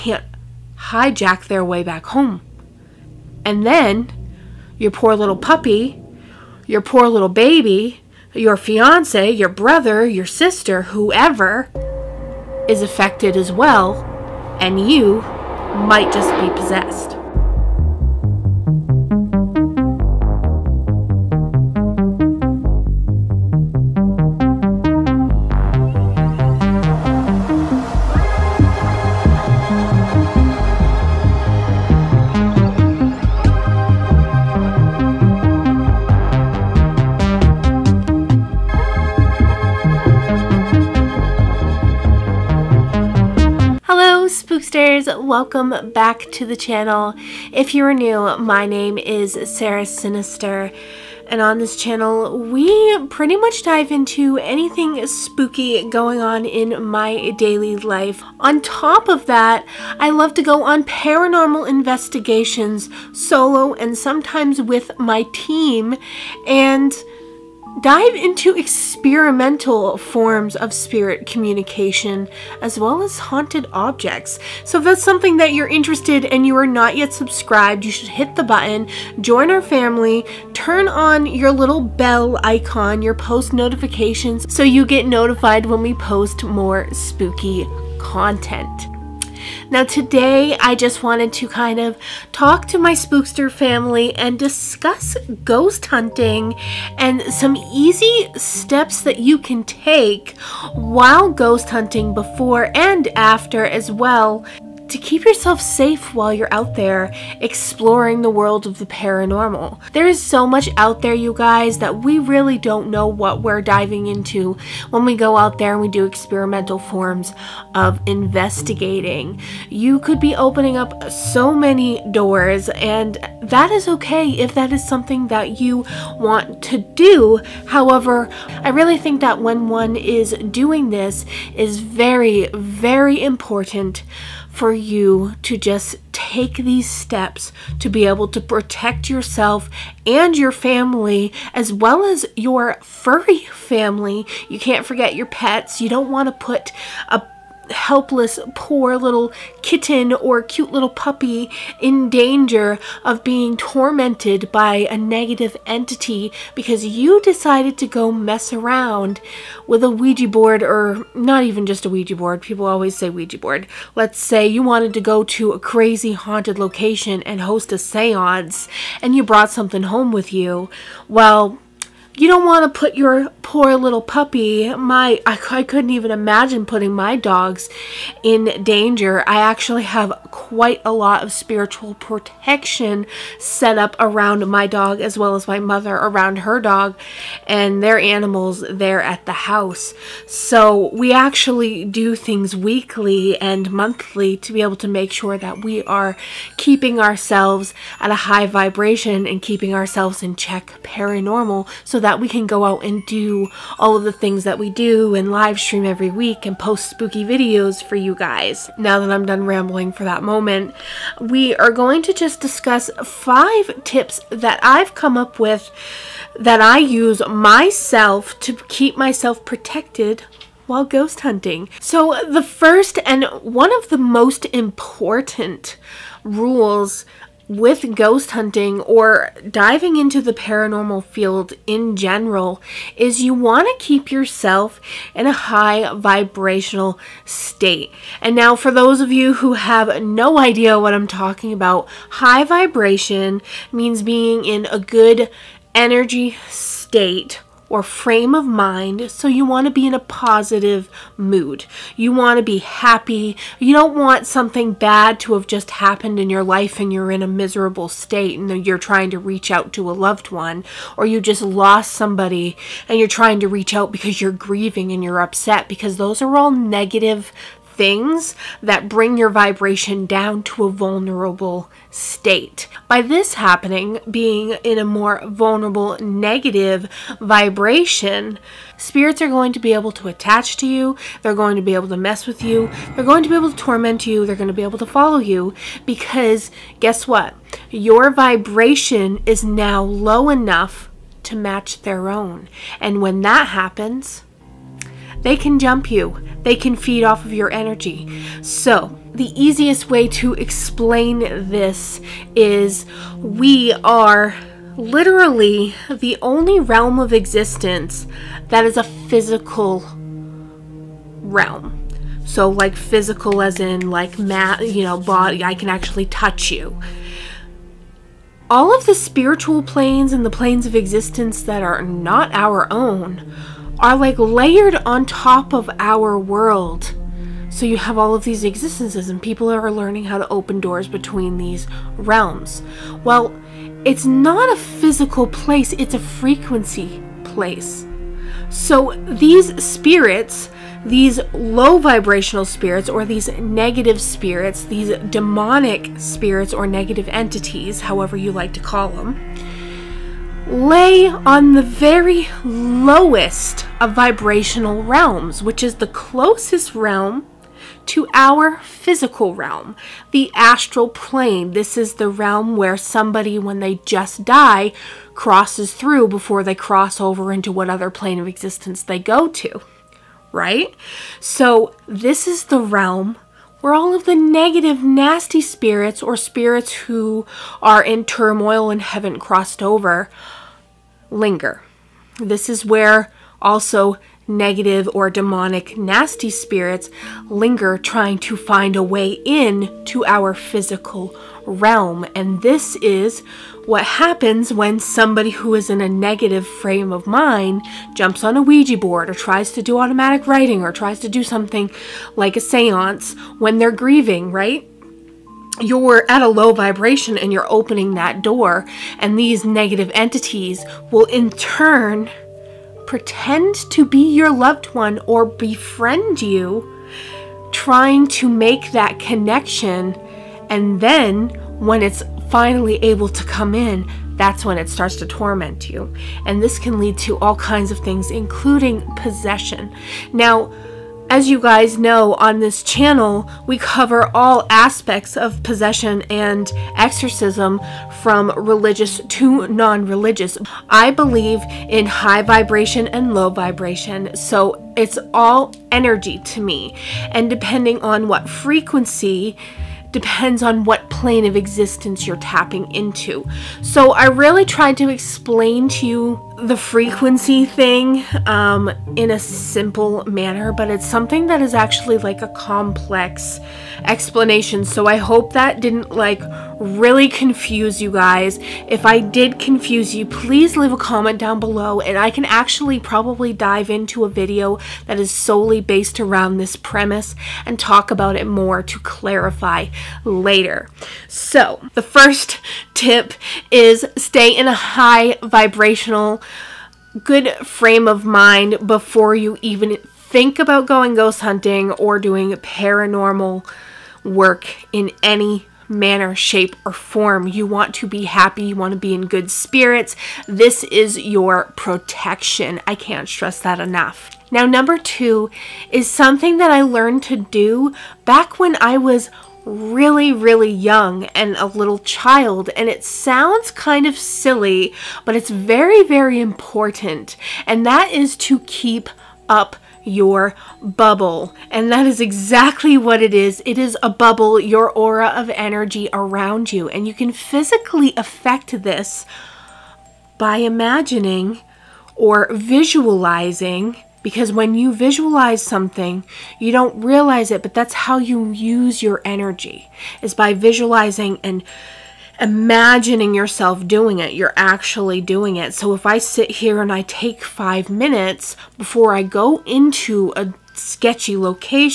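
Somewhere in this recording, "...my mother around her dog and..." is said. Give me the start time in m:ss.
3:05.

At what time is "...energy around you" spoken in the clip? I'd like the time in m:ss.
8:45.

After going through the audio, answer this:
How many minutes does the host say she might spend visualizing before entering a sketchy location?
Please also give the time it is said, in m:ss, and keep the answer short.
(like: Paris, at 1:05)
5, at 9:07.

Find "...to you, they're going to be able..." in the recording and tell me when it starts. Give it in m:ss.
4:40.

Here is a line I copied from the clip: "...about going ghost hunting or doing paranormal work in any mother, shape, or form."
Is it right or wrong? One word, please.
wrong.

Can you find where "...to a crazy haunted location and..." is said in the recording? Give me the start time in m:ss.
2:45.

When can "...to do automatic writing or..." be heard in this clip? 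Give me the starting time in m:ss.
6:39.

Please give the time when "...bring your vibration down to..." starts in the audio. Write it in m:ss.
4:28.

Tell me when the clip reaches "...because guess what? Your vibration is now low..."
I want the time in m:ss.
4:45.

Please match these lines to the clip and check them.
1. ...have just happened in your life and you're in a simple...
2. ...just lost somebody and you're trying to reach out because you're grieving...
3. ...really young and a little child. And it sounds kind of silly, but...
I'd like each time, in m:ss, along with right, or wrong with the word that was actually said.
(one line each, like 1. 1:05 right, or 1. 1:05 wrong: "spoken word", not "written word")
1. 4:15 wrong: "miserable", not "simple"
2. 4:21 right
3. 8:30 right.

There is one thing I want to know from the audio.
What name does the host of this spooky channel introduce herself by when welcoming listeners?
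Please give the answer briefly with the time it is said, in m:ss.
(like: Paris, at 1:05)
Sara Synister, at 0:49.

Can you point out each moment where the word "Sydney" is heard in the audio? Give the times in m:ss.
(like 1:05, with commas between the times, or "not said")
not said.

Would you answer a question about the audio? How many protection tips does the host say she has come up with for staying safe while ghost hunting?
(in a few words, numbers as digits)
5.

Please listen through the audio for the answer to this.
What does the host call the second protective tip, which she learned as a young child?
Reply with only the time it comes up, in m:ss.
8:38.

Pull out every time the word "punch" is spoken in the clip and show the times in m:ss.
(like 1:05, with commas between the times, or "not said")
not said.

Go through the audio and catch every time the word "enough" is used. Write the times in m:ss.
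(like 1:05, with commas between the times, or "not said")
4:50, 8:23.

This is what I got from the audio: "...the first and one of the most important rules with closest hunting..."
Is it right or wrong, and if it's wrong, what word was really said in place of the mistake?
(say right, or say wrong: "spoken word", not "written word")
wrong: "ghost", not "closest".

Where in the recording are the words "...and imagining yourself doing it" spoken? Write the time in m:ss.
9:01.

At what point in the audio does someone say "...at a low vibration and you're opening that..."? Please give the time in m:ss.
6:46.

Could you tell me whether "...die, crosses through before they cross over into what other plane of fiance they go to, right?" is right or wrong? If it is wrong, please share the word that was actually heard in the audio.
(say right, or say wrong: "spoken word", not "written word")
wrong: "existence", not "fiance".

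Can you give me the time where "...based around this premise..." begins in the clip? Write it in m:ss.
7:55.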